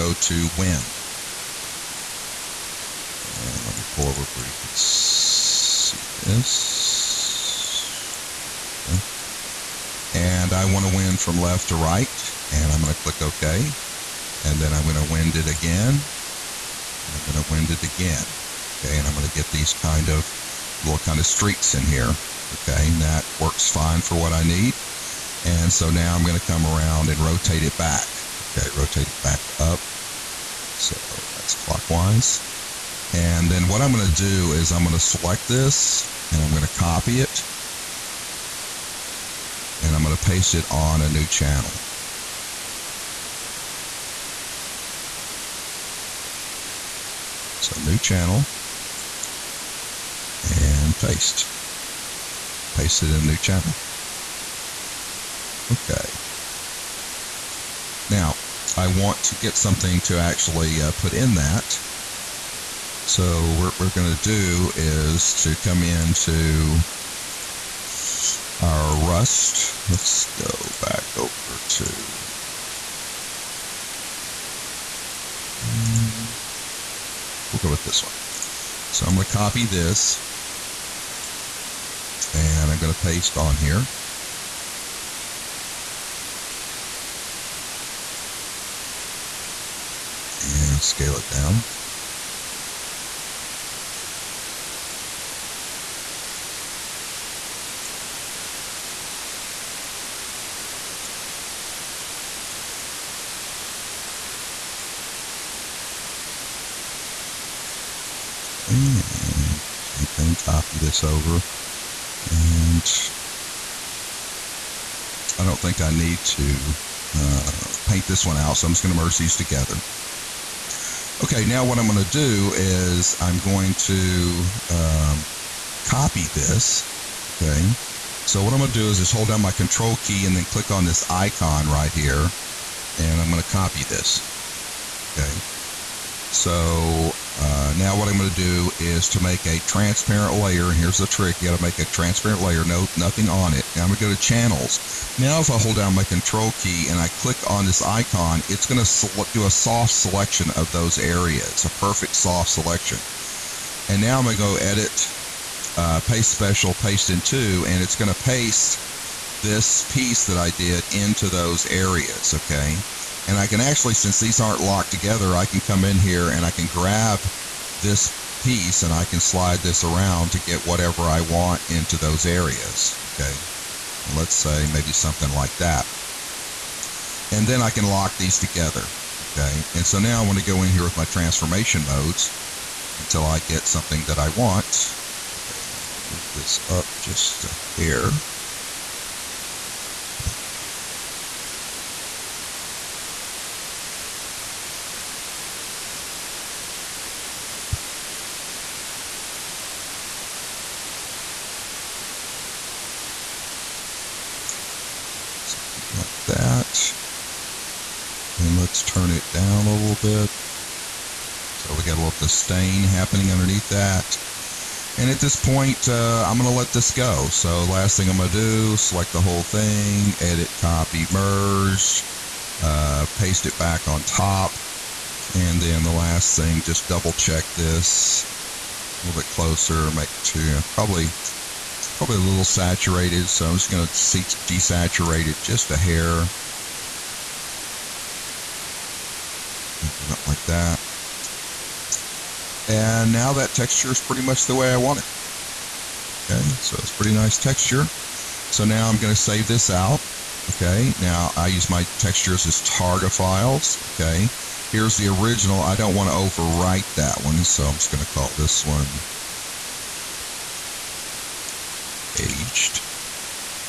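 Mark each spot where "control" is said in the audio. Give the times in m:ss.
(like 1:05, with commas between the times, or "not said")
2:09, 2:26.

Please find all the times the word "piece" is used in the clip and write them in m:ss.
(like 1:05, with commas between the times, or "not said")
2:39, 2:48.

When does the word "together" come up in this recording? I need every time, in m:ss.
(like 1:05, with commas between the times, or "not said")
1:59, 2:44, 2:58.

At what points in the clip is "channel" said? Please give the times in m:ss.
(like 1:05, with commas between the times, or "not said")
0:41, 0:47, 0:53, 2:24.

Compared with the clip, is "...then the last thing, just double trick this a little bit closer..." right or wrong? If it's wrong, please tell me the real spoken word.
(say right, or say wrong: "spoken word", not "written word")
wrong: "check", not "trick".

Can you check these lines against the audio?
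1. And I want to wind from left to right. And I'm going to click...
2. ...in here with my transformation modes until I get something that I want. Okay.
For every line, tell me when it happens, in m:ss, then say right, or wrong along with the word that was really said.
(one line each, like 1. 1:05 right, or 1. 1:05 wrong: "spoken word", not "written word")
1. 0:10 right
2. 3:00 right.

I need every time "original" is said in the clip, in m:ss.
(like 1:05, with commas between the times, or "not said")
4:15.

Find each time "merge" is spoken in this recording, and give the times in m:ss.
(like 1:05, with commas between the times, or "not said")
1:59, 3:41.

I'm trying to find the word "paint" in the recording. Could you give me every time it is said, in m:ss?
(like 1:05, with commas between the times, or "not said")
1:57.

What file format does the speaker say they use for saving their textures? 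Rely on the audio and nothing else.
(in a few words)
targa.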